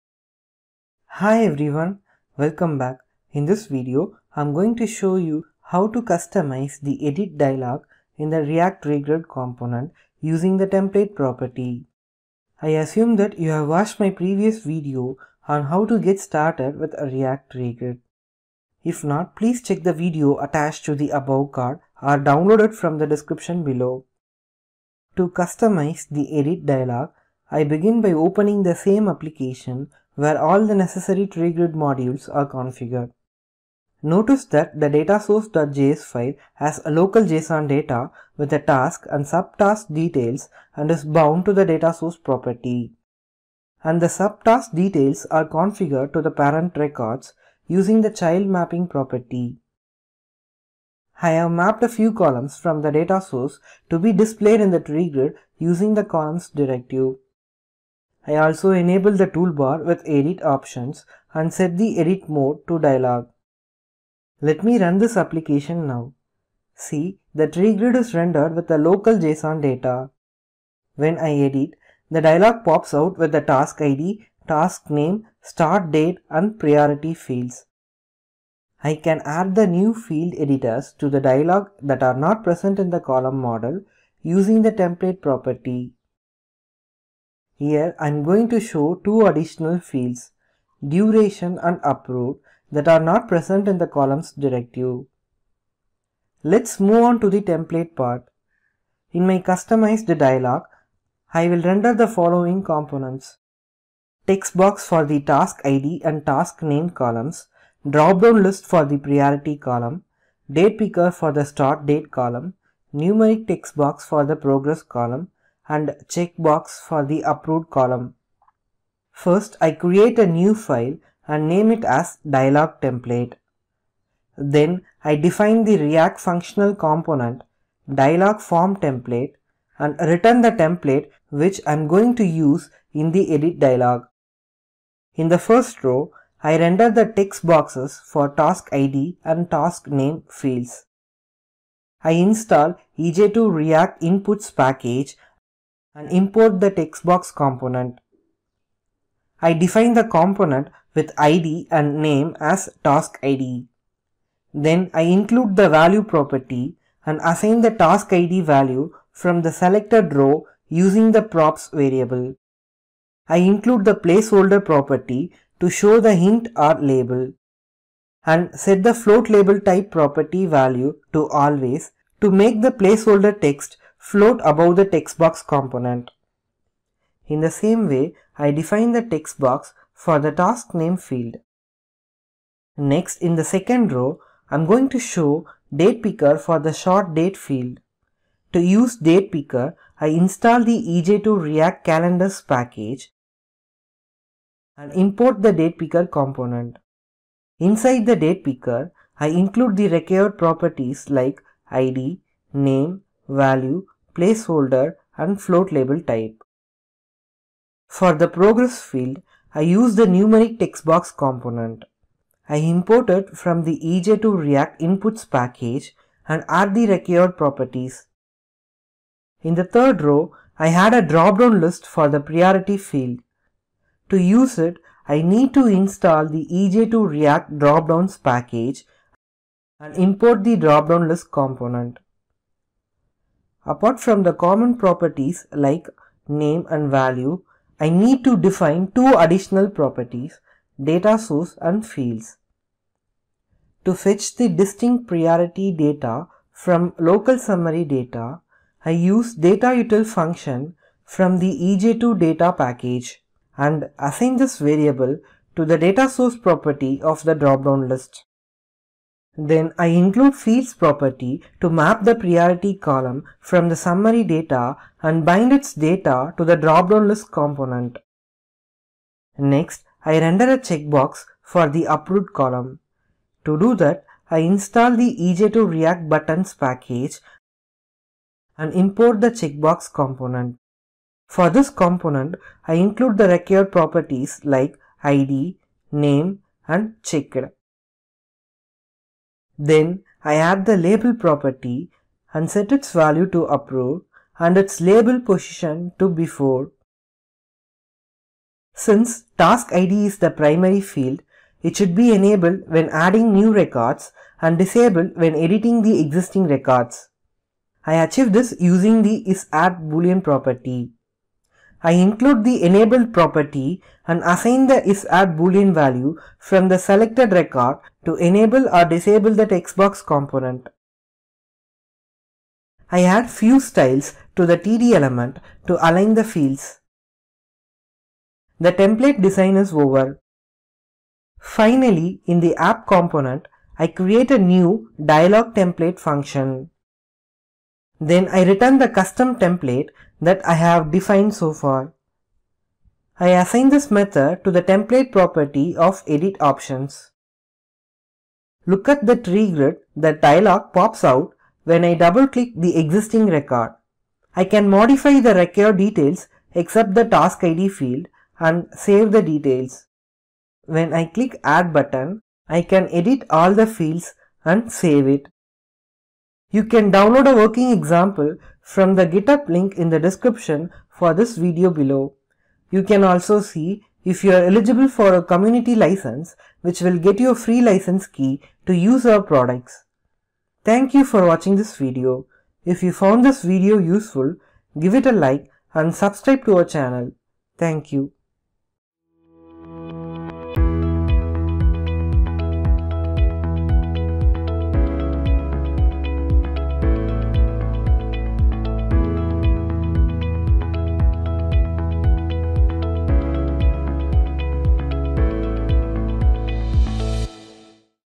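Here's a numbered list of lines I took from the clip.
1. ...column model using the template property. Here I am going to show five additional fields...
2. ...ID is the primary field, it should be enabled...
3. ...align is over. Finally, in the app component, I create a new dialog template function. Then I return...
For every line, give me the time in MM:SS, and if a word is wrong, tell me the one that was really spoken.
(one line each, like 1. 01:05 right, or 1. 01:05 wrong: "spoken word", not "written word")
1. 01:22 wrong: "two", not "five"
2. 04:59 right
3. 05:29 wrong: "design", not "align".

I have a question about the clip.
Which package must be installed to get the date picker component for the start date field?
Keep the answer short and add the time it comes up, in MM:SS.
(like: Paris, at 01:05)
EJ2 React calendars, at 03:10.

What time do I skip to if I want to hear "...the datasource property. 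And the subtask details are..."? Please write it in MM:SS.
00:41.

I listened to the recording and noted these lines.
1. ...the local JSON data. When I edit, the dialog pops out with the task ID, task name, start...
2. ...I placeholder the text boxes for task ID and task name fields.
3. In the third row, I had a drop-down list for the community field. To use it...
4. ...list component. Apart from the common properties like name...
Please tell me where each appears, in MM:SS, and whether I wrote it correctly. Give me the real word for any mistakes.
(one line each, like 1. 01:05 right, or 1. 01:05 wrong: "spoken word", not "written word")
1. 01:08 right
2. 02:16 wrong: "render", not "placeholder"
3. 03:39 wrong: "priority", not "community"
4. 03:51 right.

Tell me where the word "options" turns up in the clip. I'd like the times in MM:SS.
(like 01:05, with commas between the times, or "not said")
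01:00, 05:46.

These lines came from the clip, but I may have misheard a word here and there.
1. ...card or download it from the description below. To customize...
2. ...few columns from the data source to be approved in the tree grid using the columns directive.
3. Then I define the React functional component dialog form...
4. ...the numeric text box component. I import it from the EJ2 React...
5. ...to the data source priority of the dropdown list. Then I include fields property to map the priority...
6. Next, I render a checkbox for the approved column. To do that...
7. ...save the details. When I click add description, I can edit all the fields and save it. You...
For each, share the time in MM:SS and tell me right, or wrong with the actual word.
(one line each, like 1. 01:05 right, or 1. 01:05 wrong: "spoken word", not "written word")
1. 00:21 right
2. 00:51 wrong: "displayed", not "approved"
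3. 02:04 right
4. 03:29 right
5. 04:15 wrong: "property", not "priority"
6. 04:29 right
7. 05:58 wrong: "button", not "description".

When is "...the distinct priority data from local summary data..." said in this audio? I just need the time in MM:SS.
04:04.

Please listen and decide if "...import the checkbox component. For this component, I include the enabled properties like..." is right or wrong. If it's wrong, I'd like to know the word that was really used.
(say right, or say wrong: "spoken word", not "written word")
wrong: "required", not "enabled".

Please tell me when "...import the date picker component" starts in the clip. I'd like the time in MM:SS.
03:14.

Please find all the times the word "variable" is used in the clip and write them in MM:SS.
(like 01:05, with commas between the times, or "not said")
02:41, 04:14.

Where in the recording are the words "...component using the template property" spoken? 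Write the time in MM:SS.
00:09.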